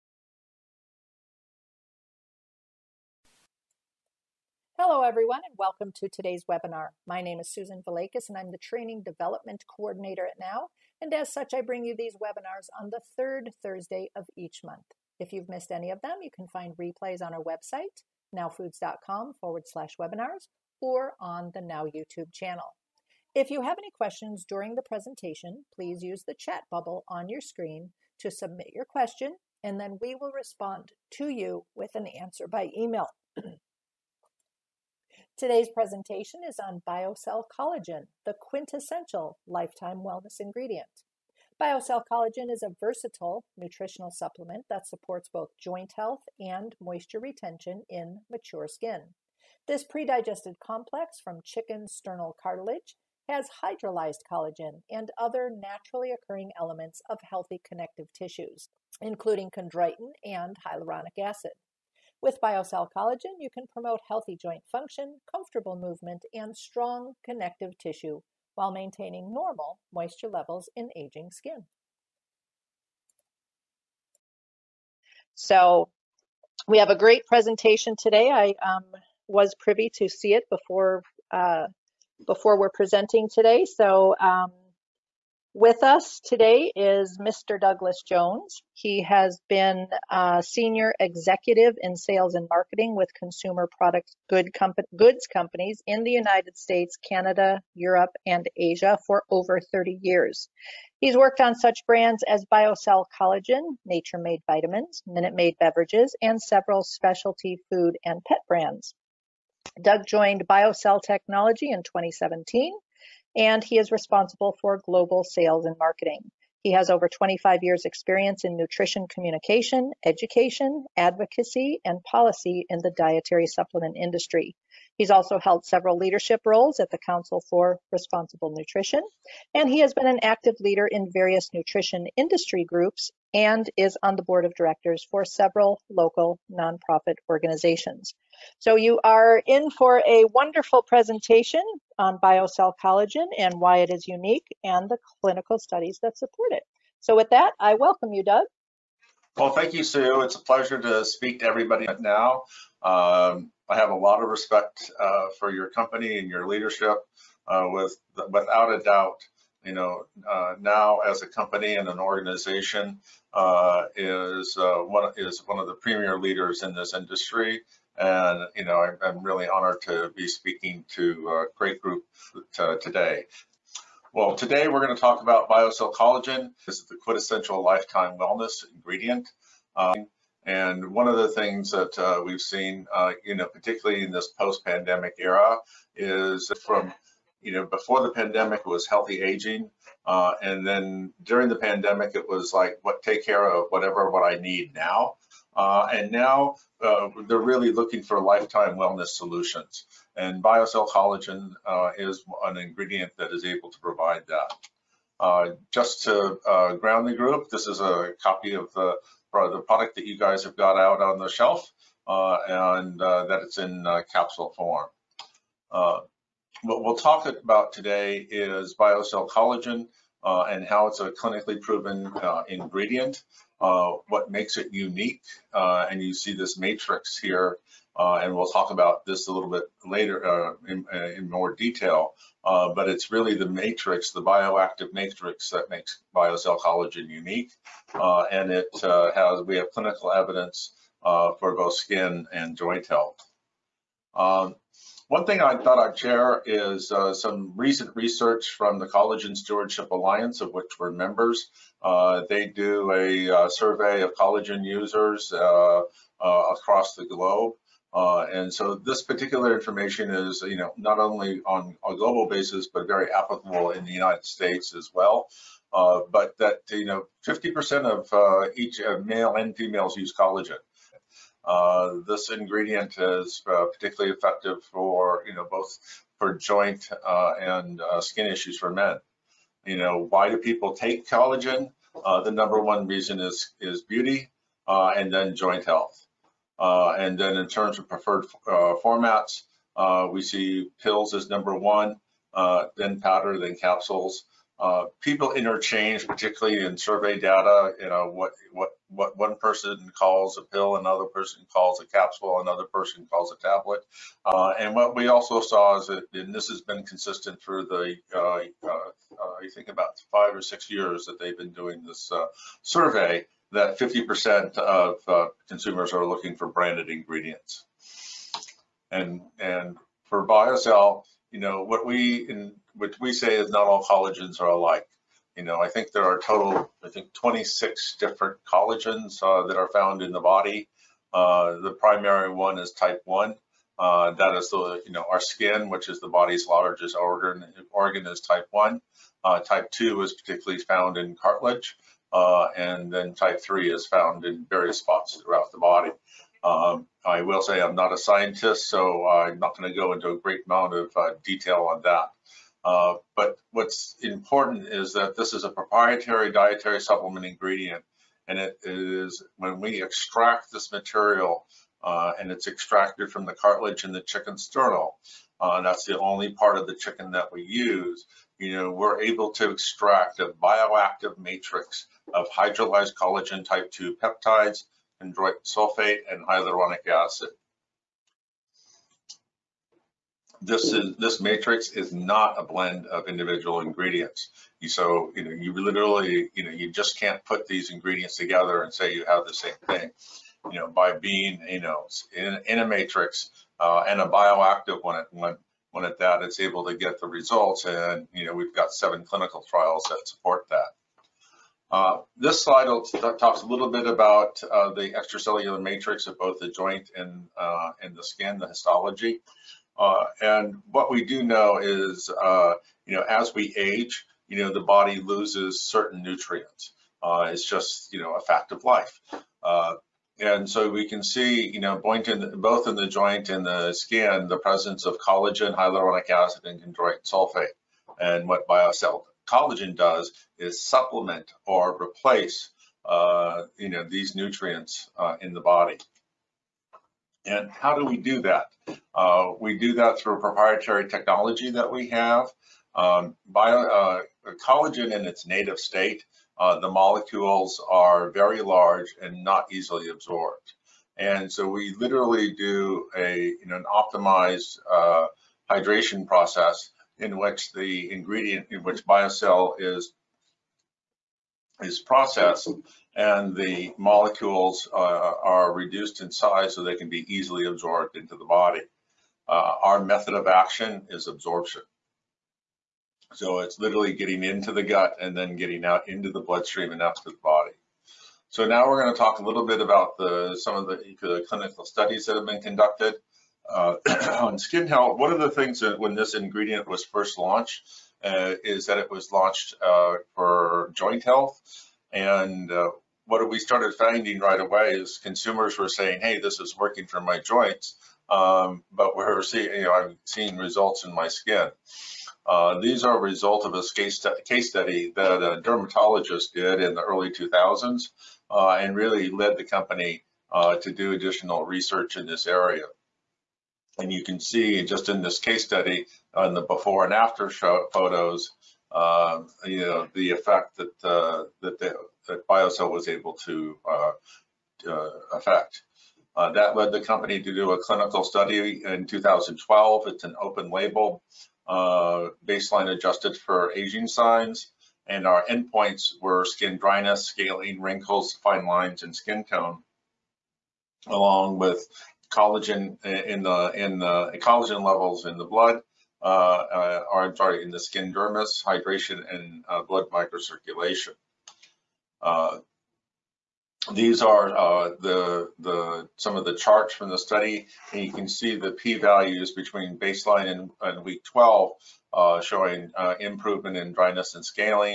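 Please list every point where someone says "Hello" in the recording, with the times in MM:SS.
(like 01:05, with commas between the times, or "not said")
00:04.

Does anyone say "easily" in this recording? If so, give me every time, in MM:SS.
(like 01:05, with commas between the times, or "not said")
07:29, 07:47.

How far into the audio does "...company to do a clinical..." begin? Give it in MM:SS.
08:46.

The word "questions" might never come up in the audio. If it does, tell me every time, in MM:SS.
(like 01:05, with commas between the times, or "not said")
00:23, 00:28.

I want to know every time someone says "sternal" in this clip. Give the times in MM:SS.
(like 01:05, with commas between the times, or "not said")
00:51, 06:04.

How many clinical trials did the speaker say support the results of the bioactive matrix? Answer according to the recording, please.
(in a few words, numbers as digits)
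7.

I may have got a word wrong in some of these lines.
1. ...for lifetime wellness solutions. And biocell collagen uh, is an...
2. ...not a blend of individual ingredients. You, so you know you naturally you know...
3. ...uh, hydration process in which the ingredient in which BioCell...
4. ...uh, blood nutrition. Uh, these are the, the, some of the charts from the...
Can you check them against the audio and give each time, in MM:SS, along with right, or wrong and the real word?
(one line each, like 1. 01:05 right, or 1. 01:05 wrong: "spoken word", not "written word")
1. 03:18 right
2. 06:21 wrong: "literally", not "naturally"
3. 07:34 right
4. 09:09 wrong: "microcirculation", not "nutrition".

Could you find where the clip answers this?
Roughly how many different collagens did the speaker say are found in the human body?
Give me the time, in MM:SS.
05:27.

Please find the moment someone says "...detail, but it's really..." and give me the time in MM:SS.
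03:51.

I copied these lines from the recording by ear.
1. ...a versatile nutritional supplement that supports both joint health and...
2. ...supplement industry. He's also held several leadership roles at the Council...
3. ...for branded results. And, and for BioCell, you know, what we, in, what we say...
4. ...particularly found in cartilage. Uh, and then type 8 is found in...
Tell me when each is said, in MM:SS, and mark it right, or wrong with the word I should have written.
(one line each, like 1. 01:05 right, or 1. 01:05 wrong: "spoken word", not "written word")
1. 00:42 right
2. 02:03 right
3. 05:16 wrong: "ingredients", not "results"
4. 05:40 wrong: "3", not "8".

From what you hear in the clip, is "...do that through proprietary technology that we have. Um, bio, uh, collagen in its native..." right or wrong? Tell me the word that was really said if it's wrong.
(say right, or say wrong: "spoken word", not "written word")
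right.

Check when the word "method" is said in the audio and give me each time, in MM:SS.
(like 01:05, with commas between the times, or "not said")
07:49.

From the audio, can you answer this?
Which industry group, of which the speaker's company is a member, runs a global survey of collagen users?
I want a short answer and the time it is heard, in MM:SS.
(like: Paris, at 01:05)
Collagen Stewardship Alliance, at 04:08.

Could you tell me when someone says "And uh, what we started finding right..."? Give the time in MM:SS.
08:11.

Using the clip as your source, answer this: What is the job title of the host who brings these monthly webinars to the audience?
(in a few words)
Training Development Coordinator.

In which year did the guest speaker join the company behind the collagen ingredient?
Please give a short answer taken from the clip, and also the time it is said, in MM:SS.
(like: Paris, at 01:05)
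2017, at 01:51.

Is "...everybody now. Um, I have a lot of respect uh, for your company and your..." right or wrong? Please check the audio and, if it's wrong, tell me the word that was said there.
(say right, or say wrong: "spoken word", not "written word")
right.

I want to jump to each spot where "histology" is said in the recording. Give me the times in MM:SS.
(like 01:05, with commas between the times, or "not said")
06:48.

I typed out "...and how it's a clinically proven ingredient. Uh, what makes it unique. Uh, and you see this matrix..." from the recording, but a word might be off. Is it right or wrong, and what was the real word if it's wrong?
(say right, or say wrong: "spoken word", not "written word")
right.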